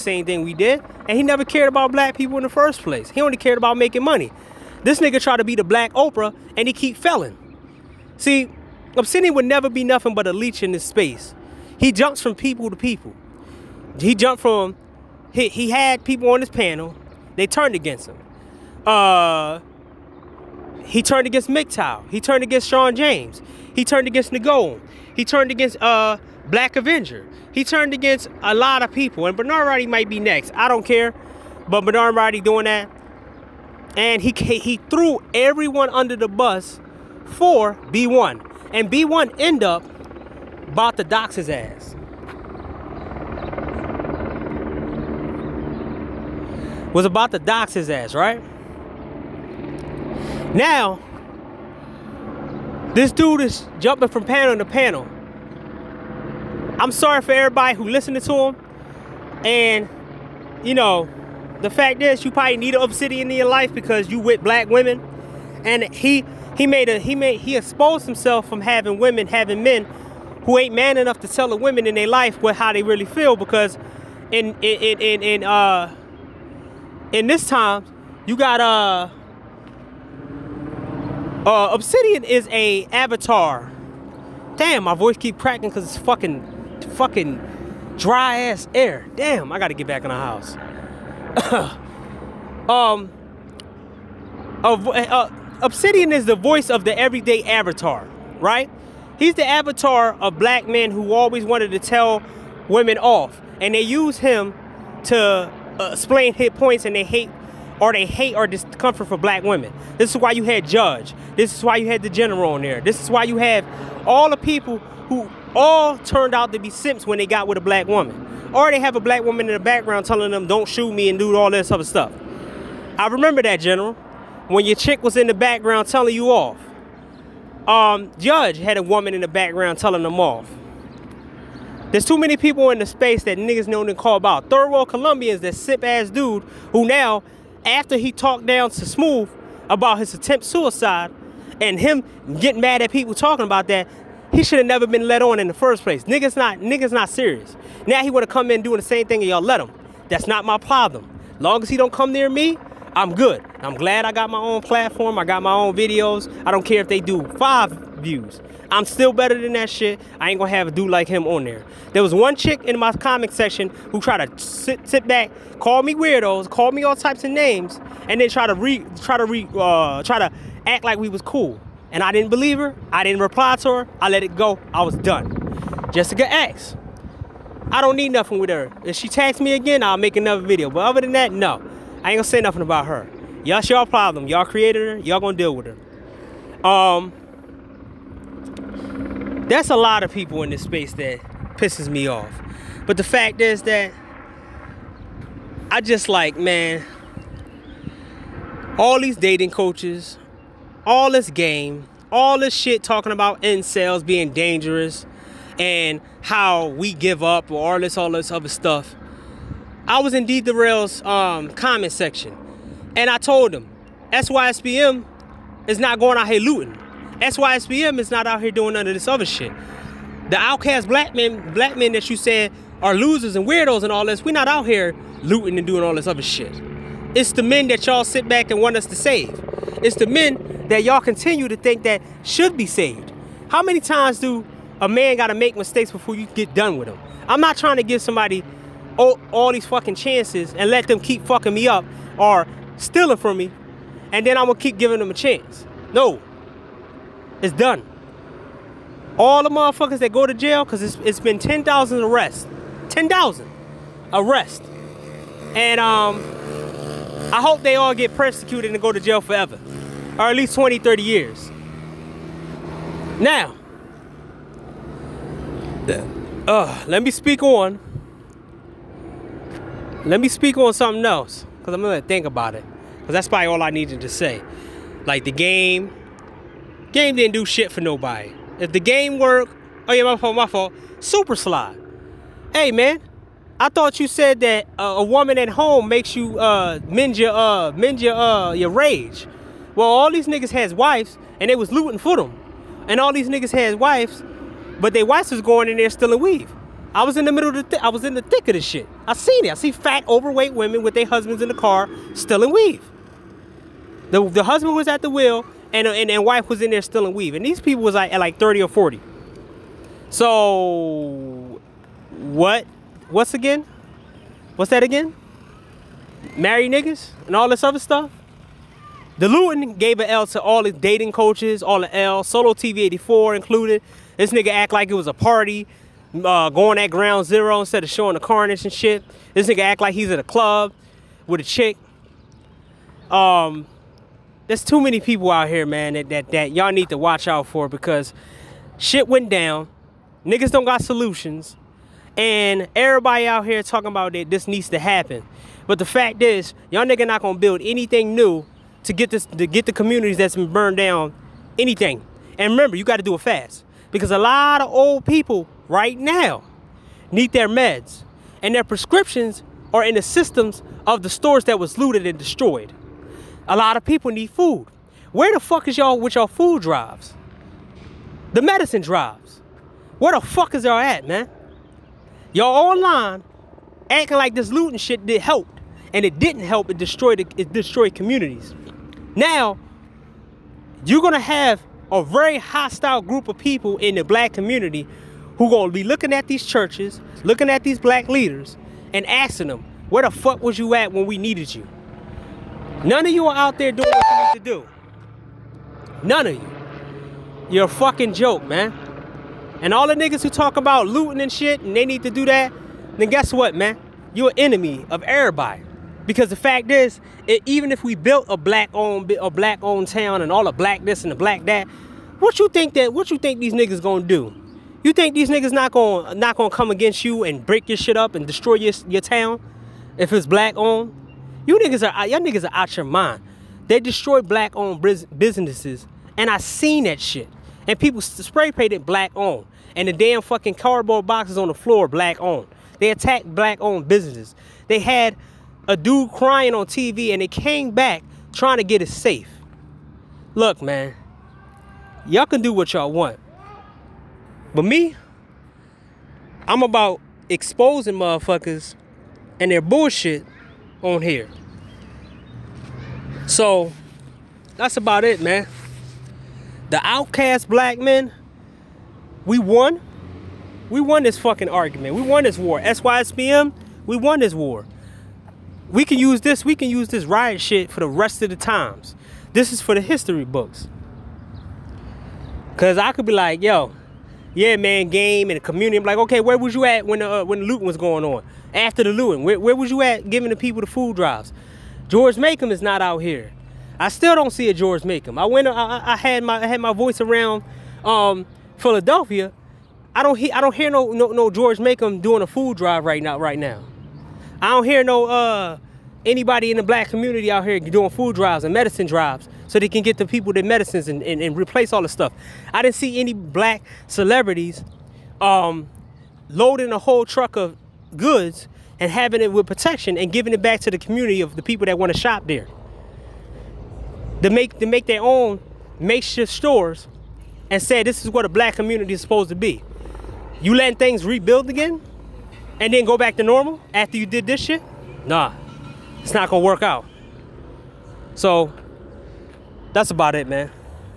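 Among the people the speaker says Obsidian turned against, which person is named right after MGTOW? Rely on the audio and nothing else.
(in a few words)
Sean James.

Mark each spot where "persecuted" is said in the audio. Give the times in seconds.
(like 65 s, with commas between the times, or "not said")
258 s.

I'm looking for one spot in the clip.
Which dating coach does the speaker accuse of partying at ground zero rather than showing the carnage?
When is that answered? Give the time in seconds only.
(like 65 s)
322 s.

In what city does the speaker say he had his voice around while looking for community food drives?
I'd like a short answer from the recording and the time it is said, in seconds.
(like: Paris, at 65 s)
Philadelphia, at 488 s.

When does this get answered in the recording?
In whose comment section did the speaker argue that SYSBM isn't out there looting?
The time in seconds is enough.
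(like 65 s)
210 s.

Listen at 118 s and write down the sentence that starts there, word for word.
Or they have a black woman in the background telling them, don't shoot me and do all this other stuff.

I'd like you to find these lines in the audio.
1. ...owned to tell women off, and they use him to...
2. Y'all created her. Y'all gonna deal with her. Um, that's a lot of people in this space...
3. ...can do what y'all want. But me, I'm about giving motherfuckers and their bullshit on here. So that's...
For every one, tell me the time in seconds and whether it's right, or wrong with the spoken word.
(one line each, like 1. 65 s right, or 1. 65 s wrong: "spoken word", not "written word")
1. 101 s wrong: "wanted", not "owned"
2. 184 s right
3. 442 s wrong: "exposing", not "giving".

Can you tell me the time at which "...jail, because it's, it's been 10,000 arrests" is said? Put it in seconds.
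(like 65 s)
250 s.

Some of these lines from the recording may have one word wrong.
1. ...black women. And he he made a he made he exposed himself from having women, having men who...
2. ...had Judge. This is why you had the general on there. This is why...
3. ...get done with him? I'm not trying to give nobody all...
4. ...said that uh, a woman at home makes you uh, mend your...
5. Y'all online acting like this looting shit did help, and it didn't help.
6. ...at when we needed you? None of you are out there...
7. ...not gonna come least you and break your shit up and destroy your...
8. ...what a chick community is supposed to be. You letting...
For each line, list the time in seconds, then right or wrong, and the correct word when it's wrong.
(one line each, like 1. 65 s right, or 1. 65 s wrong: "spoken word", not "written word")
1. 64 s right
2. 110 s right
3. 236 s wrong: "somebody", not "nobody"
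4. 284 s right
5. 372 s right
6. 390 s right
7. 416 s wrong: "against", not "least"
8. 518 s wrong: "black", not "chick".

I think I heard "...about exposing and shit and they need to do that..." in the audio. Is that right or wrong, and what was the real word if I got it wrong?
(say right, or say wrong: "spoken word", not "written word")
wrong: "looting", not "exposing".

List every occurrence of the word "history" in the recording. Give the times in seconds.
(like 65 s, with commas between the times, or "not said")
469 s.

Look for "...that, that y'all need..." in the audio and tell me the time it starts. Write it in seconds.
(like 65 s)
336 s.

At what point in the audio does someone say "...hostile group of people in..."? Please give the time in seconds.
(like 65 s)
382 s.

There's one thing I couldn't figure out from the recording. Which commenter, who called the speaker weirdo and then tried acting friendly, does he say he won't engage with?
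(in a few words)
Jessica X.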